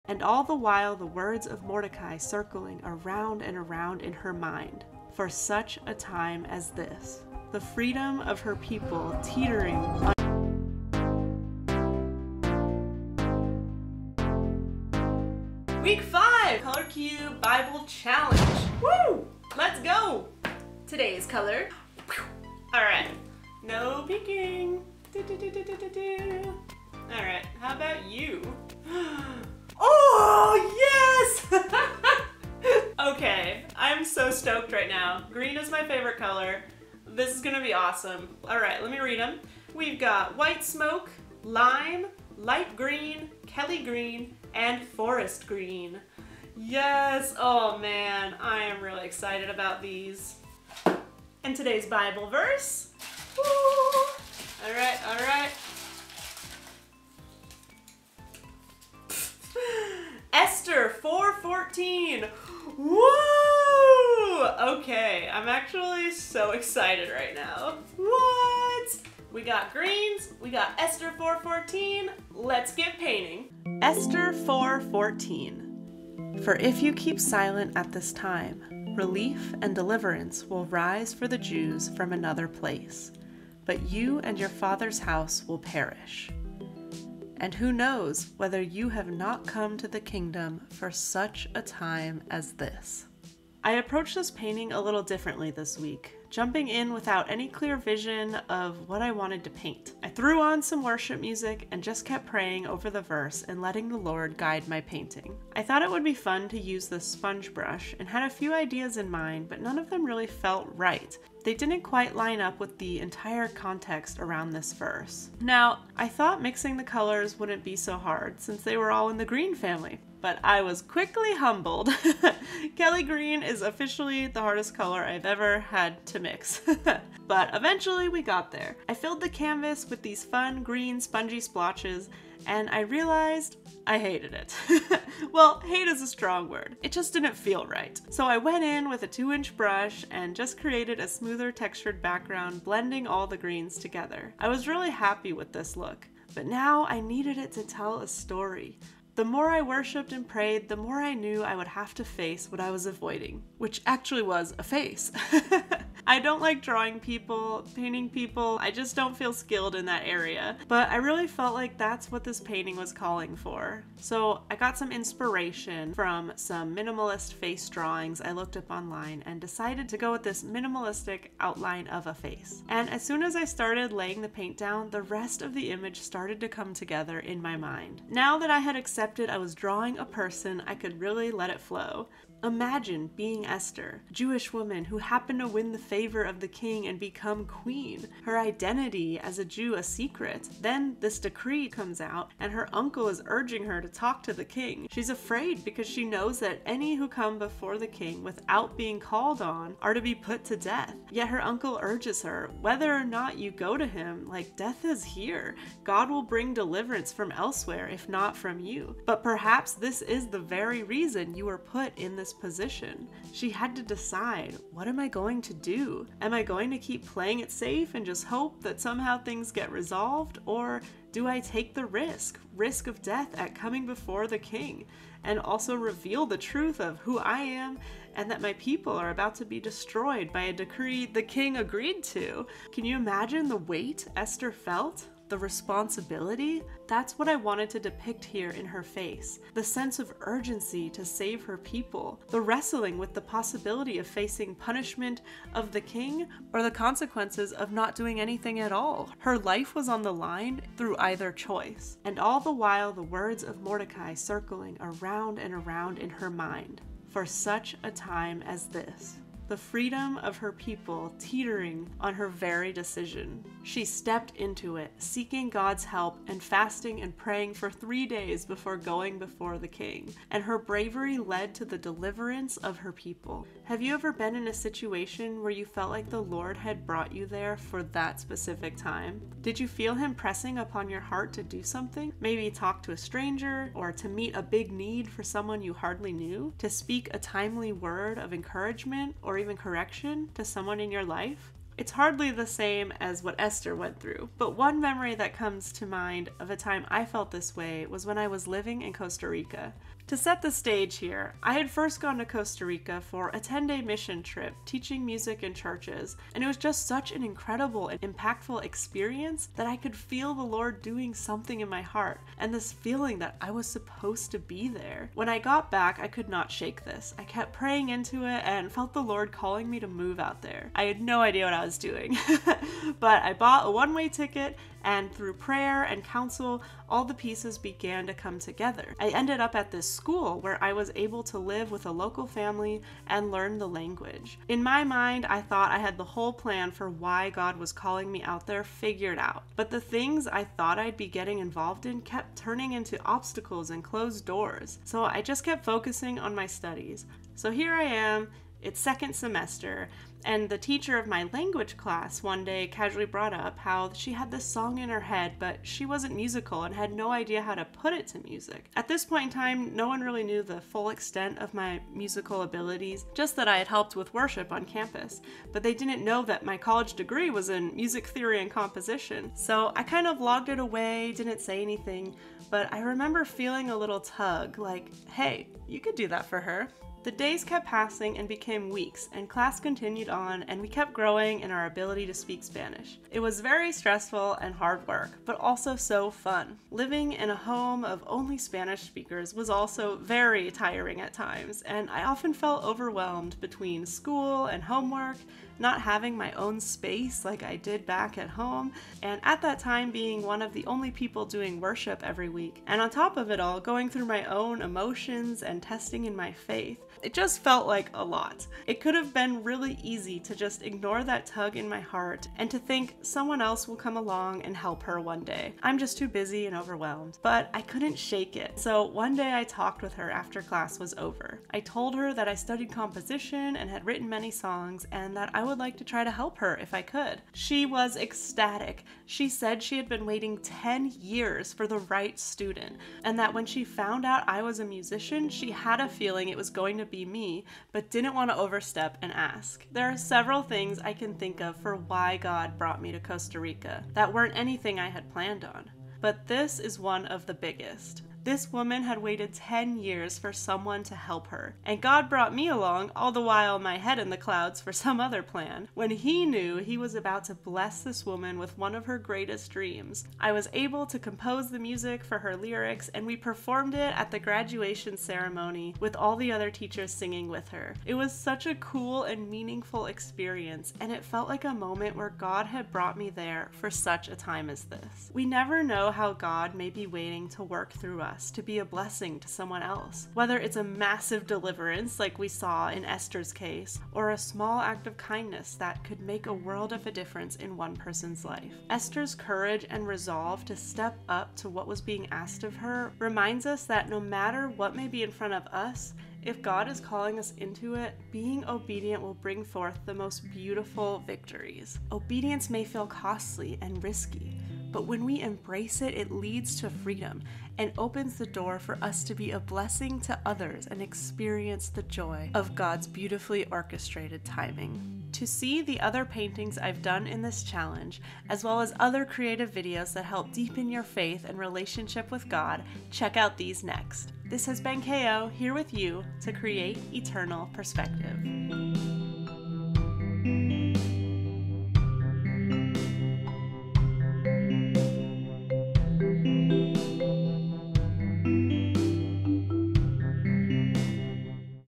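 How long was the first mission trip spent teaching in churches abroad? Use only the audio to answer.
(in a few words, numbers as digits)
10 days.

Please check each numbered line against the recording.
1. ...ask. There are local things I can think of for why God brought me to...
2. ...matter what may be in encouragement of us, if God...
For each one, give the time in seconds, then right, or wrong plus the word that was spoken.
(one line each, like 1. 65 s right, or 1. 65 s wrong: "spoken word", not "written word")
1. 439 s wrong: "several", not "local"
2. 493 s wrong: "front", not "encouragement".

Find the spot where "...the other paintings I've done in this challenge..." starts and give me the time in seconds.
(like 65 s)
515 s.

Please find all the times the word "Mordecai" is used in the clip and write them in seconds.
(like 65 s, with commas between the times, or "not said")
1 s, 253 s.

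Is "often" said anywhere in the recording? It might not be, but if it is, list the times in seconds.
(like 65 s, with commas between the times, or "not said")
392 s.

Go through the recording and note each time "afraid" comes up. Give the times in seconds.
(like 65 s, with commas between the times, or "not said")
195 s.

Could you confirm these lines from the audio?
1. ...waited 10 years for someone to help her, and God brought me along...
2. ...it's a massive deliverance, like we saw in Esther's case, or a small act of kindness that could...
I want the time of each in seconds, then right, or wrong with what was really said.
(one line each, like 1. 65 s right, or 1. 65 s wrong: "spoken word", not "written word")
1. 448 s right
2. 480 s right.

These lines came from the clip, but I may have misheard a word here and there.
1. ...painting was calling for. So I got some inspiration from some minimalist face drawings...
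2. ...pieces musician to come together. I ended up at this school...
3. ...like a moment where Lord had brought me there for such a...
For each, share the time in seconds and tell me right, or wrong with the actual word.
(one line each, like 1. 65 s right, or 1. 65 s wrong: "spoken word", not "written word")
1. 162 s right
2. 327 s wrong: "began", not "musician"
3. 471 s wrong: "God", not "Lord".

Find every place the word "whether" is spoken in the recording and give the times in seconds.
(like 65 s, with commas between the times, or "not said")
88 s, 202 s, 480 s.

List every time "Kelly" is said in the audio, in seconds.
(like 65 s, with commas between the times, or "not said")
43 s, 122 s.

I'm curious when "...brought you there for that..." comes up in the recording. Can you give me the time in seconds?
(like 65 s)
276 s.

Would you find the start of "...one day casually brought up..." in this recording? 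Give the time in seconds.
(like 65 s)
352 s.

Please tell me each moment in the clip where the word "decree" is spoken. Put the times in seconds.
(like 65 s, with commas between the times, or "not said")
191 s, 230 s.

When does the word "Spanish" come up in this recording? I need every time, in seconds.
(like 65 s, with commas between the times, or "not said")
382 s, 388 s.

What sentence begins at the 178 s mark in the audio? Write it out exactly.
Now that I had accepted accepted I was drawing a person, I could really let it flow.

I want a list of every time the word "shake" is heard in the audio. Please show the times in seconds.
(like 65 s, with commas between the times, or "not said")
316 s, 417 s.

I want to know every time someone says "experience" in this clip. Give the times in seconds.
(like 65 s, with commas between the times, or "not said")
308 s, 469 s, 510 s.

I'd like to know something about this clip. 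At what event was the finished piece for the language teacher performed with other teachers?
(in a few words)
Graduation ceremony.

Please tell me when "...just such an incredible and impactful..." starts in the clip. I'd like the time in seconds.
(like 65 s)
306 s.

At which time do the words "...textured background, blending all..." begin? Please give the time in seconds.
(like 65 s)
141 s.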